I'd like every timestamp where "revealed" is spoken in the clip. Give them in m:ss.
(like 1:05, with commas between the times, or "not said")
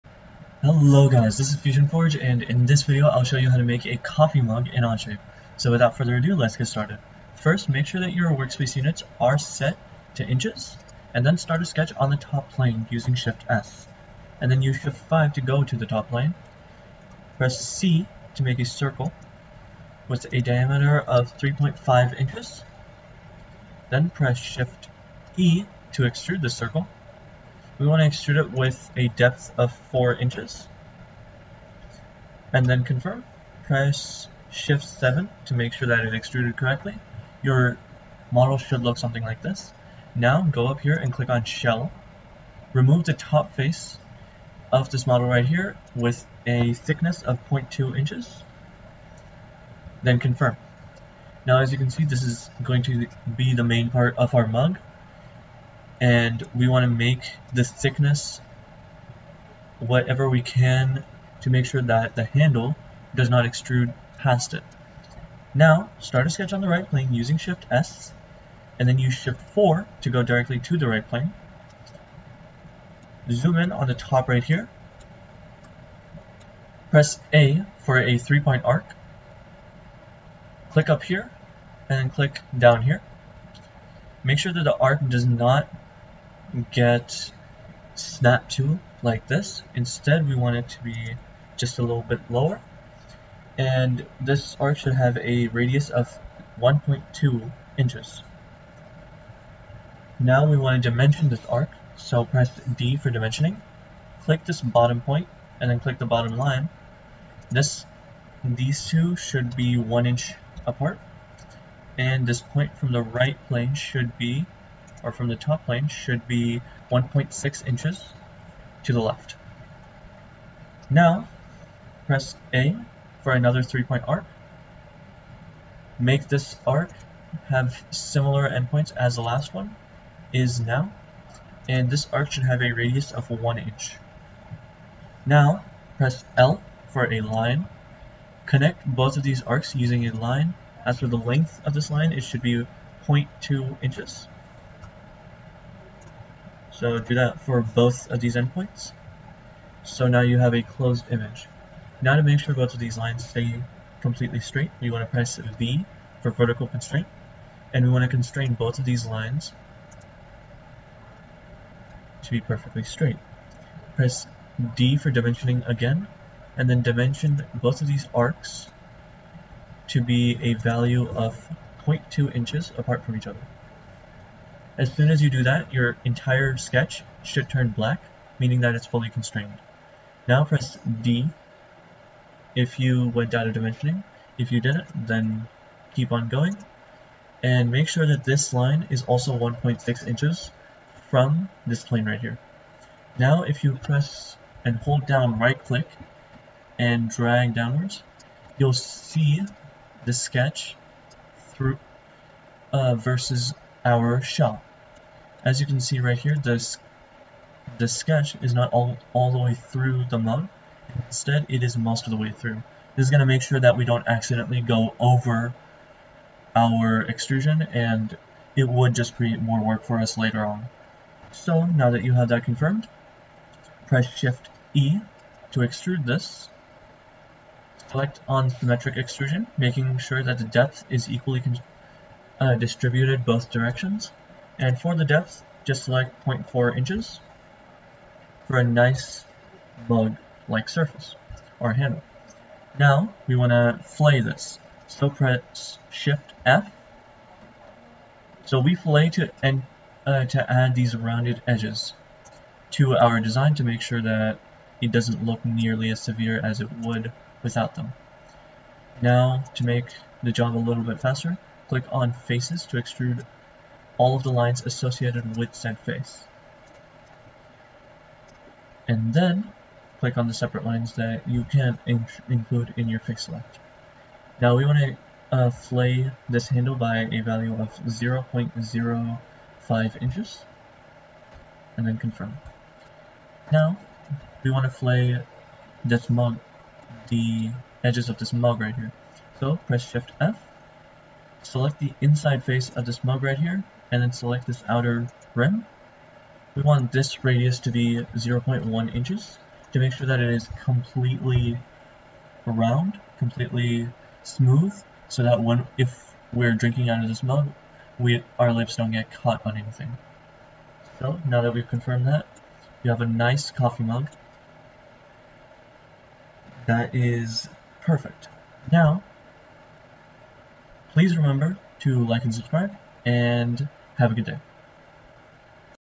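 not said.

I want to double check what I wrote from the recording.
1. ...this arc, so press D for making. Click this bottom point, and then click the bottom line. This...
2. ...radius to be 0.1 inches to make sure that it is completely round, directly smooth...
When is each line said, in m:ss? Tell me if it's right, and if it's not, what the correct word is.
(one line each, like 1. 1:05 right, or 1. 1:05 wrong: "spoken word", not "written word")
1. 1:41 wrong: "dimensioning", not "making"
2. 4:57 wrong: "completely", not "directly".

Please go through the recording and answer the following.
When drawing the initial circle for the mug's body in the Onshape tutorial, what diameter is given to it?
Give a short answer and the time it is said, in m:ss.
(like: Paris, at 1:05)
3.5 inches, at 0:21.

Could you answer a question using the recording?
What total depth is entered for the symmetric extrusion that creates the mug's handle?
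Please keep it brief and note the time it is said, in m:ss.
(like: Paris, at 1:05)
0.4 inches, at 3:56.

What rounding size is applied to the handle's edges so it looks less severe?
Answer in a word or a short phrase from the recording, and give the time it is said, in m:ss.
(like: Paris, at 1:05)
0.05 inches, at 4:37.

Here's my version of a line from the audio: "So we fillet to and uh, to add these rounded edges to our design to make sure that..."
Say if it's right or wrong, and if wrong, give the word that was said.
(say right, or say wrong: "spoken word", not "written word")
right.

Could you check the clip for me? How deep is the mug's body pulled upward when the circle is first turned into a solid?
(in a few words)
4 inches.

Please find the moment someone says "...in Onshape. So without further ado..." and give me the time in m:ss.
0:04.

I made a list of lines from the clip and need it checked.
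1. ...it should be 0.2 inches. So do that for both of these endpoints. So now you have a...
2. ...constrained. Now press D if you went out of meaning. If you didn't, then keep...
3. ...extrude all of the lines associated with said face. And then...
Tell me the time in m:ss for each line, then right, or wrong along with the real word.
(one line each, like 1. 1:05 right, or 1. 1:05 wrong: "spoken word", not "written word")
1. 2:22 right
2. 2:59 wrong: "dimensioning", not "meaning"
3. 4:22 right.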